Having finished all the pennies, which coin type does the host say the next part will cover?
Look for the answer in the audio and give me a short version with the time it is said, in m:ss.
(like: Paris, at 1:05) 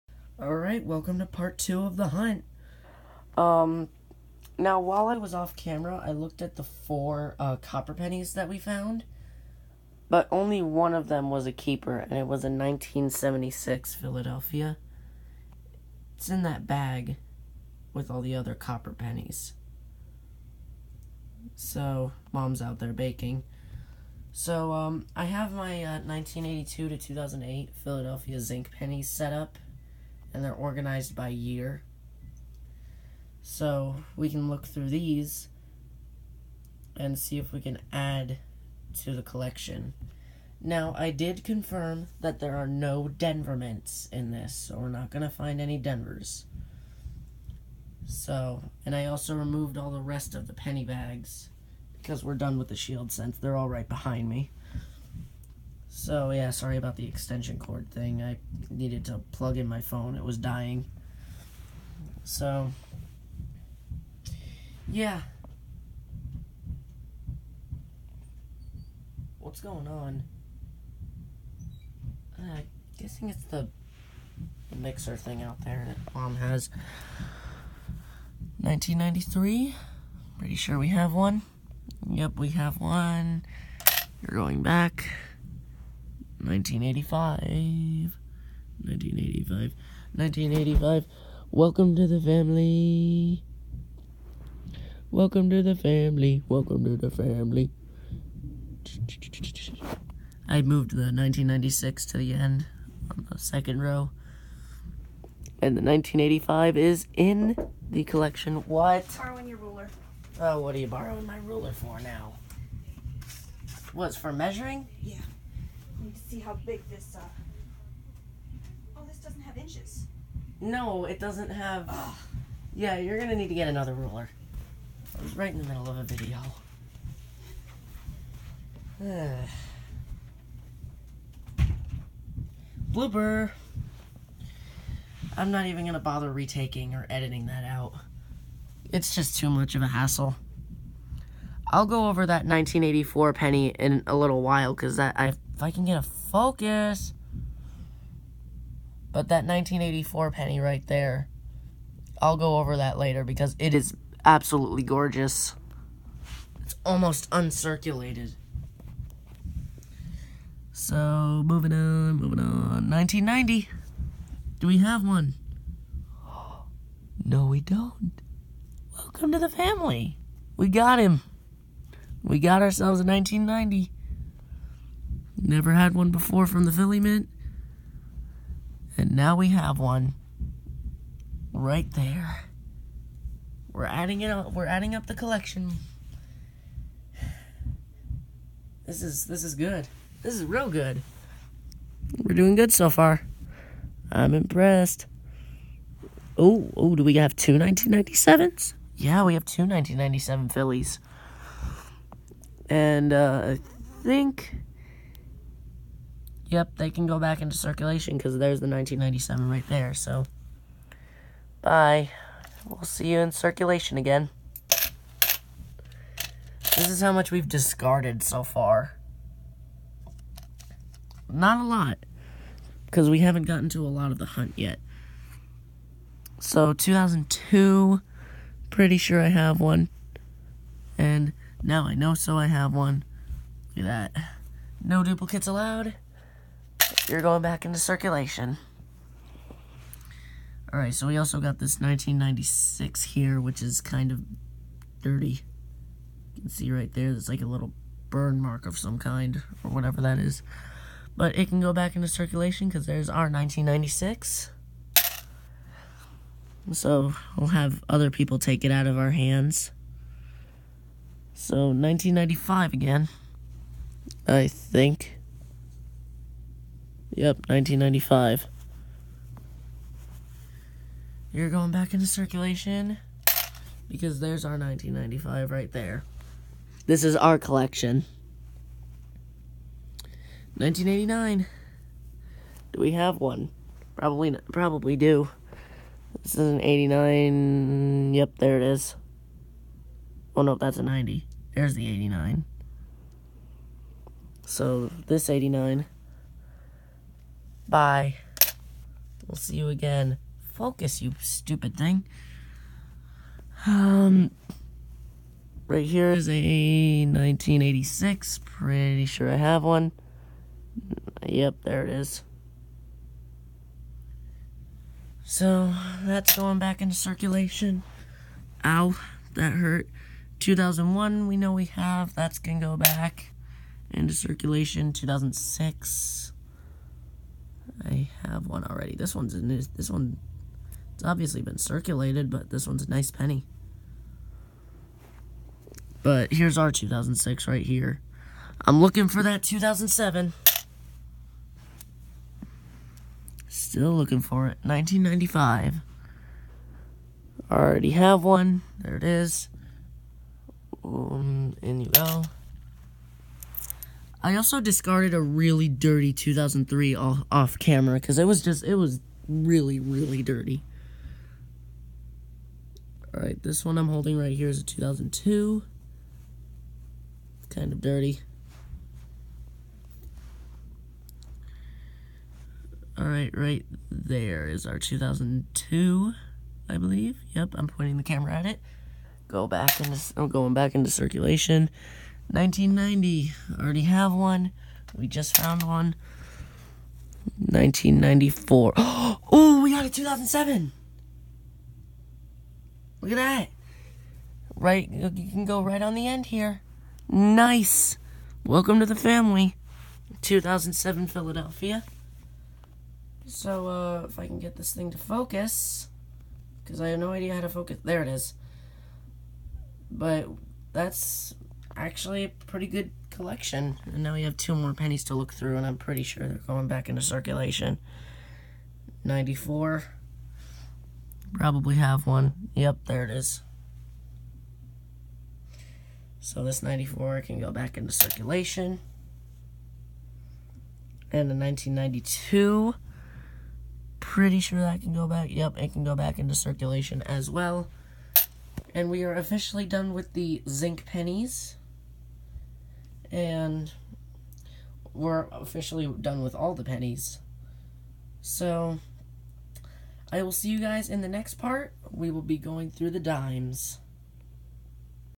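dimes, at 7:32.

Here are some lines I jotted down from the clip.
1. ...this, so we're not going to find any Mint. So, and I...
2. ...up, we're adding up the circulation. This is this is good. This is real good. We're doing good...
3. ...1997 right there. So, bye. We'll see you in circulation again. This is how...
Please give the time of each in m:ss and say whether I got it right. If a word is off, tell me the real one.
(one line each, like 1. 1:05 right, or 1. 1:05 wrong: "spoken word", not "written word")
1. 0:44 wrong: "Denvers", not "Mint"
2. 3:04 wrong: "collection", not "circulation"
3. 3:28 right.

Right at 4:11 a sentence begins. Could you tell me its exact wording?
But it can go back into circulation because there's our 1996.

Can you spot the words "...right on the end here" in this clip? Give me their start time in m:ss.
6:35.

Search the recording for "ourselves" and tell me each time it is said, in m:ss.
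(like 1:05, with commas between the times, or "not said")
2:52.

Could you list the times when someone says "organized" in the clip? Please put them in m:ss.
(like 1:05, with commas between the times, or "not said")
0:30.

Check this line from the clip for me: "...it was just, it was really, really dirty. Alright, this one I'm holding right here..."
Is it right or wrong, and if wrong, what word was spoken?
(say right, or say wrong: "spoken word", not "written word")
right.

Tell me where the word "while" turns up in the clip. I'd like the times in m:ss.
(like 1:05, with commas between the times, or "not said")
0:04, 2:24.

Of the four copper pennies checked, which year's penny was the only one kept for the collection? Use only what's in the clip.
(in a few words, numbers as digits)
1976.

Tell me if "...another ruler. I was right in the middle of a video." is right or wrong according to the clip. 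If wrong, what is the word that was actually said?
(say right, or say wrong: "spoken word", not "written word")
right.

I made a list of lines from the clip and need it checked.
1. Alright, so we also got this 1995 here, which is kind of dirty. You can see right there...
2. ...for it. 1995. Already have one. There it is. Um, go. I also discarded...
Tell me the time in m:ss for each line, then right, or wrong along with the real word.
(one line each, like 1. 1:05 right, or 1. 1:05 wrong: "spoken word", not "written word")
1. 4:00 wrong: "1996", not "1995"
2. 5:44 right.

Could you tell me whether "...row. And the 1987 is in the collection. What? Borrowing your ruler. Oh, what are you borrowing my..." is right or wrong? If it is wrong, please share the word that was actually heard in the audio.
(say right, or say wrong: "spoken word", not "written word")
wrong: "1985", not "1987".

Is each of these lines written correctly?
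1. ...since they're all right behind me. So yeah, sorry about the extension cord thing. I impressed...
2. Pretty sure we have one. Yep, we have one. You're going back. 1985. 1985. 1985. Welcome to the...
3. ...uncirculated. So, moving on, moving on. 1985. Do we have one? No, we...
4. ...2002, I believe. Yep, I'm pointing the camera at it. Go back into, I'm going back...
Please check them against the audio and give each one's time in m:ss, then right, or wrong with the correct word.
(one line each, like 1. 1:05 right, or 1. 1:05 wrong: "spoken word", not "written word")
1. 0:53 wrong: "needed", not "impressed"
2. 1:20 right
3. 2:37 wrong: "1990", not "1985"
4. 6:14 right.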